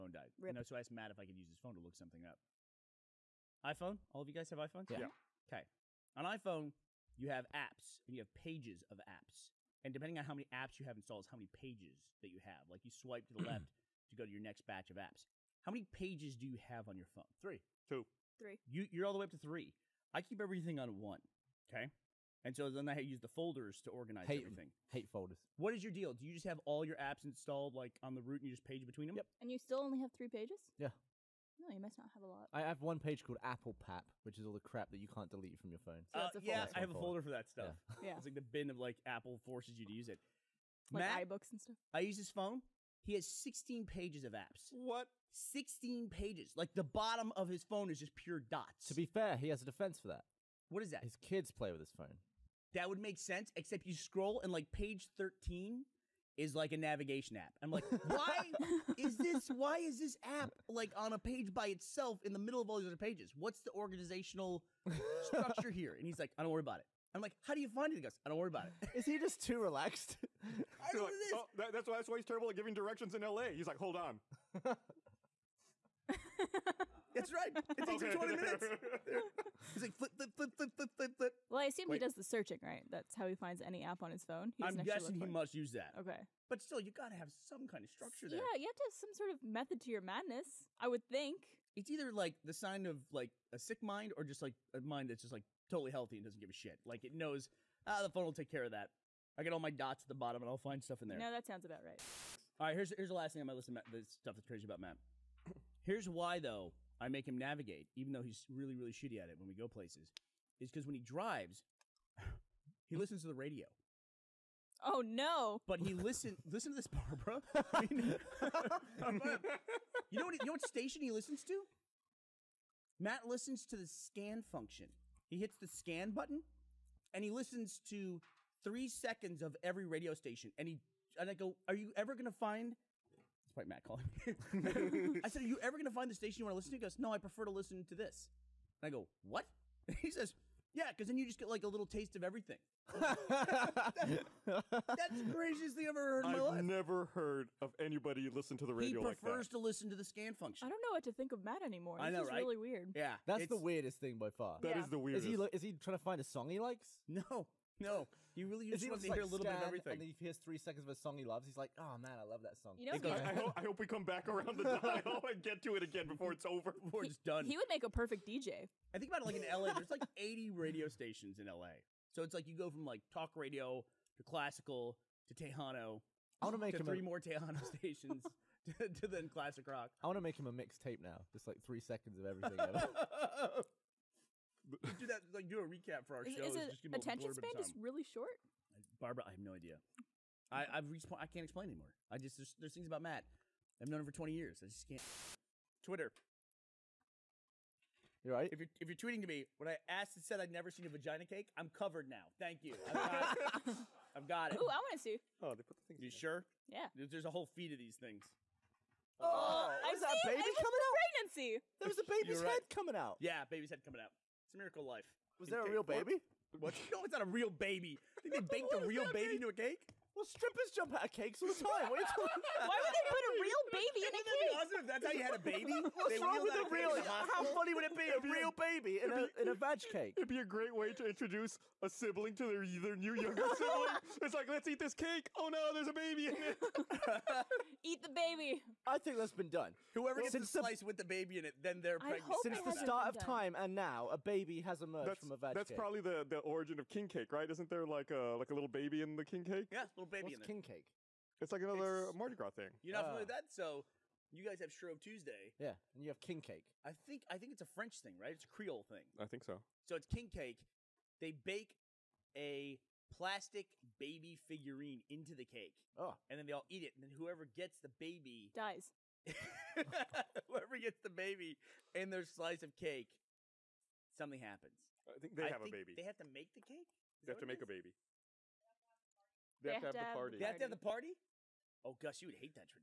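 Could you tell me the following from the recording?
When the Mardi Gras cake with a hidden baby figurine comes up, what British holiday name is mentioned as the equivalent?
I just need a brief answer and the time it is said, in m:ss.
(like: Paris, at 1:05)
Shrove Tuesday, at 4:14.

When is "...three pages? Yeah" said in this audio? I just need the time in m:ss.
0:30.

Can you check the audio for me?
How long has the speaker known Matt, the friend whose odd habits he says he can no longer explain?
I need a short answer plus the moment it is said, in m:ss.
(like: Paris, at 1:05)
20 years, at 3:14.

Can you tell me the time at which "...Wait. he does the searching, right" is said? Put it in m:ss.
1:21.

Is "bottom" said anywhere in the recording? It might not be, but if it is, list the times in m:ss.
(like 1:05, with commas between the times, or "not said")
0:46, 1:40.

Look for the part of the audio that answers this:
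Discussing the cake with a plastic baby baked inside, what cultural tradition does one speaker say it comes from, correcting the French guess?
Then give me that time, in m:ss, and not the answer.
4:18.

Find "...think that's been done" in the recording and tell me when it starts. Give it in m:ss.
3:58.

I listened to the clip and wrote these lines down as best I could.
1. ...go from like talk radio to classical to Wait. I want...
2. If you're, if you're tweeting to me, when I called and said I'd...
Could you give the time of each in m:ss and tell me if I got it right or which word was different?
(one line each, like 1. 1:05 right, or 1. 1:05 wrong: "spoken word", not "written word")
1. 2:52 wrong: "Tejano", not "Wait"
2. 3:18 wrong: "asked", not "called".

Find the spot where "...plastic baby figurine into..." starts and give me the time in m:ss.
4:23.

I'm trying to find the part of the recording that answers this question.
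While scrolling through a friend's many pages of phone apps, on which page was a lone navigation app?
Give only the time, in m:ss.
0:54.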